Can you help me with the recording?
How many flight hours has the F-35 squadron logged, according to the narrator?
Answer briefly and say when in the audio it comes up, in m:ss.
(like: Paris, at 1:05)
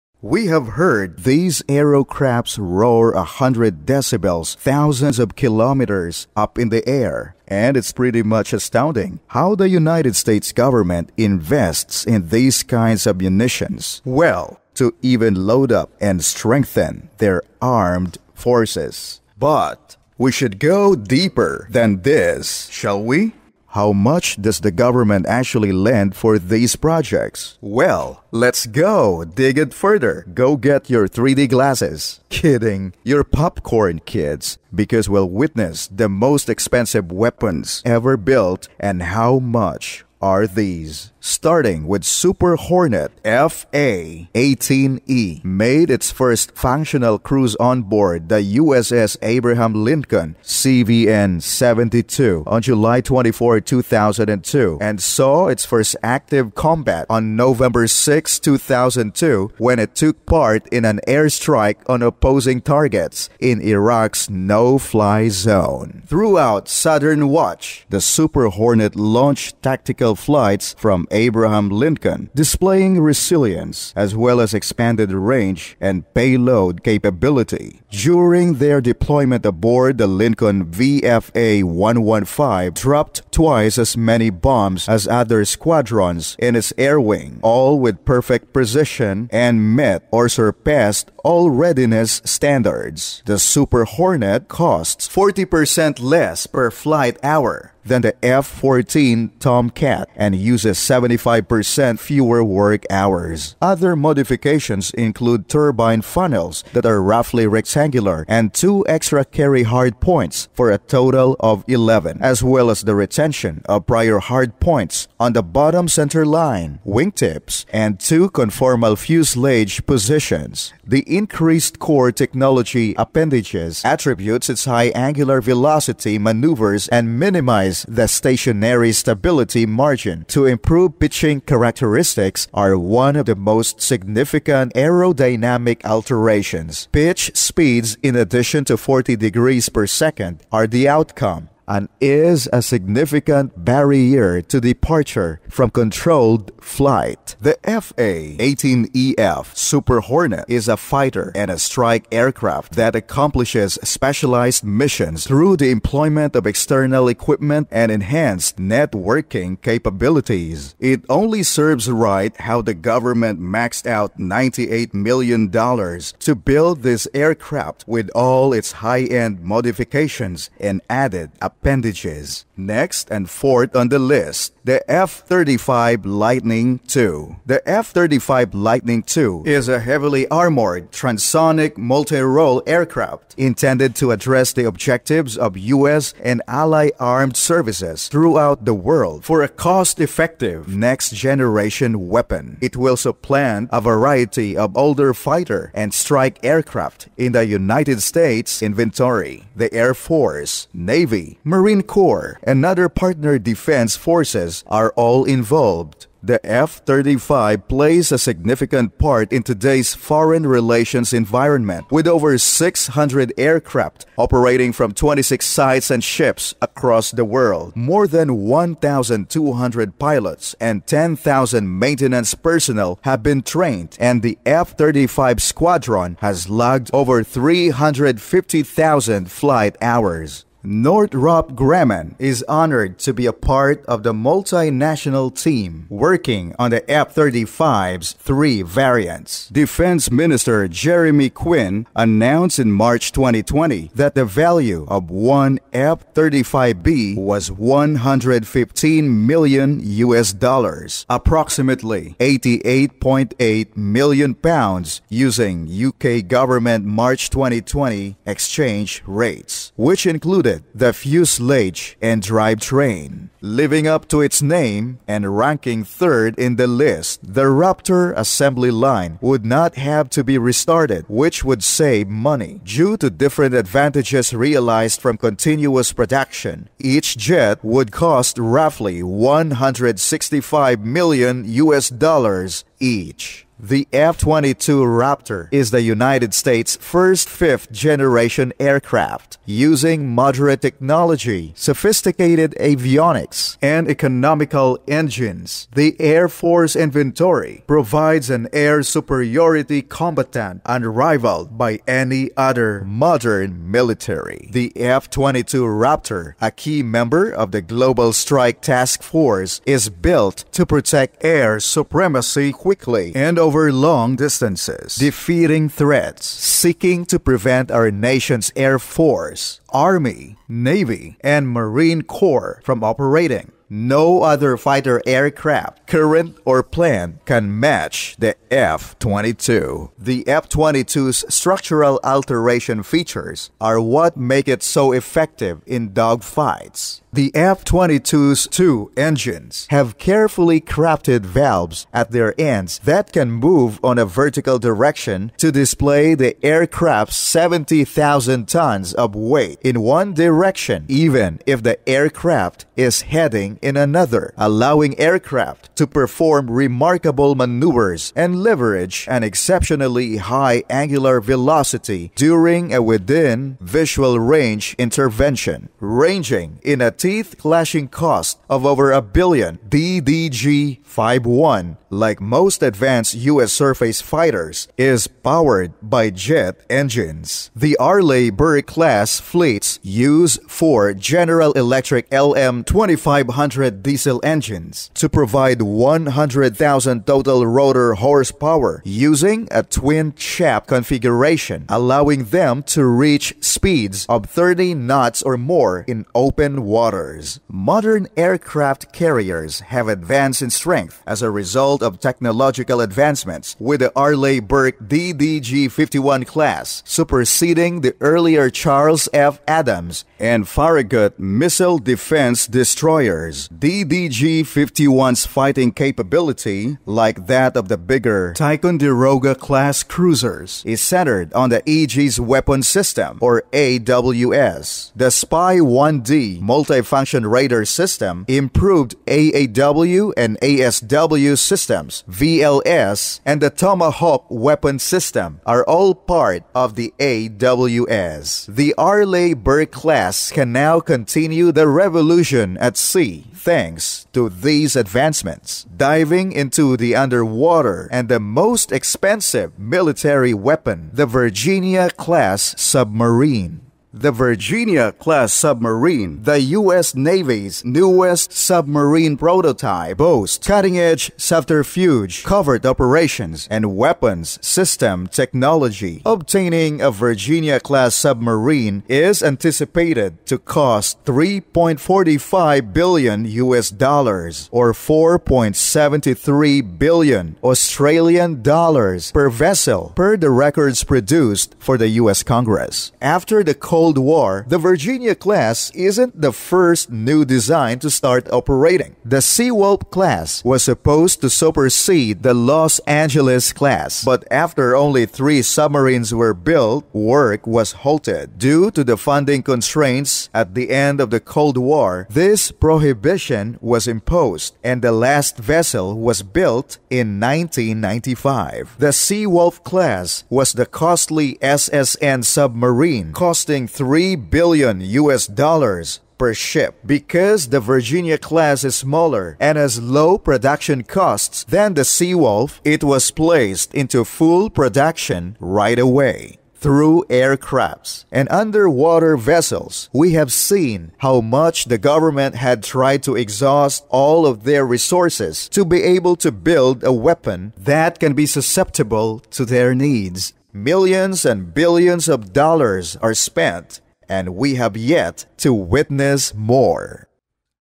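over 350,000, at 3:47.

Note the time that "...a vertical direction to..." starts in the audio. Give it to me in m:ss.
5:43.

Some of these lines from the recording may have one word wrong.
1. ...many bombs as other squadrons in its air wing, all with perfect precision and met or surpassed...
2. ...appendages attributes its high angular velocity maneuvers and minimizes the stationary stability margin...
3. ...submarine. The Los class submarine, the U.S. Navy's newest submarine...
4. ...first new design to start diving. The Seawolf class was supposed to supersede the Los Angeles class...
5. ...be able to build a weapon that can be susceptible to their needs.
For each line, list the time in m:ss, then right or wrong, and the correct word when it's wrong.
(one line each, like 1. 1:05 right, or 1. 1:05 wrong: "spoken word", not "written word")
1. 1:23 right
2. 2:02 right
3. 7:32 wrong: "Virginia", not "Los"
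4. 8:06 wrong: "operating", not "diving"
5. 8:55 right.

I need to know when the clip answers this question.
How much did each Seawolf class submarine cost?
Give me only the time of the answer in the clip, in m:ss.
8:33.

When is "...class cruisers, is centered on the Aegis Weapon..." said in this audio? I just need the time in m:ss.
6:59.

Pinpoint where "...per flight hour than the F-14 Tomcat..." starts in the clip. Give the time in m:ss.
1:36.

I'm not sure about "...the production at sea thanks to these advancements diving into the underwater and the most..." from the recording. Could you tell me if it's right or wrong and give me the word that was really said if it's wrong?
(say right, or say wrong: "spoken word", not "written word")
wrong: "revolution", not "production".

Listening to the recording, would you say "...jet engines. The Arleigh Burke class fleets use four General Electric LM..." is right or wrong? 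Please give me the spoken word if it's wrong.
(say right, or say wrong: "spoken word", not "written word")
right.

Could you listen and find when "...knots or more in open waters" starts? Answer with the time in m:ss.
6:34.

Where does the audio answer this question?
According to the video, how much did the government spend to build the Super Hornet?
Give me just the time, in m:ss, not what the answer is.
2:44.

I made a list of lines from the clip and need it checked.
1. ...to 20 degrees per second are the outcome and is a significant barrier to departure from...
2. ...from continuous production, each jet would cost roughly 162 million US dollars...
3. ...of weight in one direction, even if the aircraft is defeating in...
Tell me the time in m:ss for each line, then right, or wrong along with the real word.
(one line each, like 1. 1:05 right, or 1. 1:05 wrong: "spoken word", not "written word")
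1. 2:18 wrong: "40", not "20"
2. 4:35 wrong: "165", not "162"
3. 5:48 wrong: "heading", not "defeating".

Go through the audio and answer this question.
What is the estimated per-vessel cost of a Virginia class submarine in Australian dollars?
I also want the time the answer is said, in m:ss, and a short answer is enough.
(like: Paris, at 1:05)
4.73 billion, at 7:54.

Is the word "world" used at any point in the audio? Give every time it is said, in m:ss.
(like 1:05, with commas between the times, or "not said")
3:08, 3:37.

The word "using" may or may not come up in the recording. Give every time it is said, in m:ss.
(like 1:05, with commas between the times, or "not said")
4:15, 4:49, 6:28.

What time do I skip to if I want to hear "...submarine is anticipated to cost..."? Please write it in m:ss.
7:47.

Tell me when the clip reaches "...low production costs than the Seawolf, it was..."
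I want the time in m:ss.
8:39.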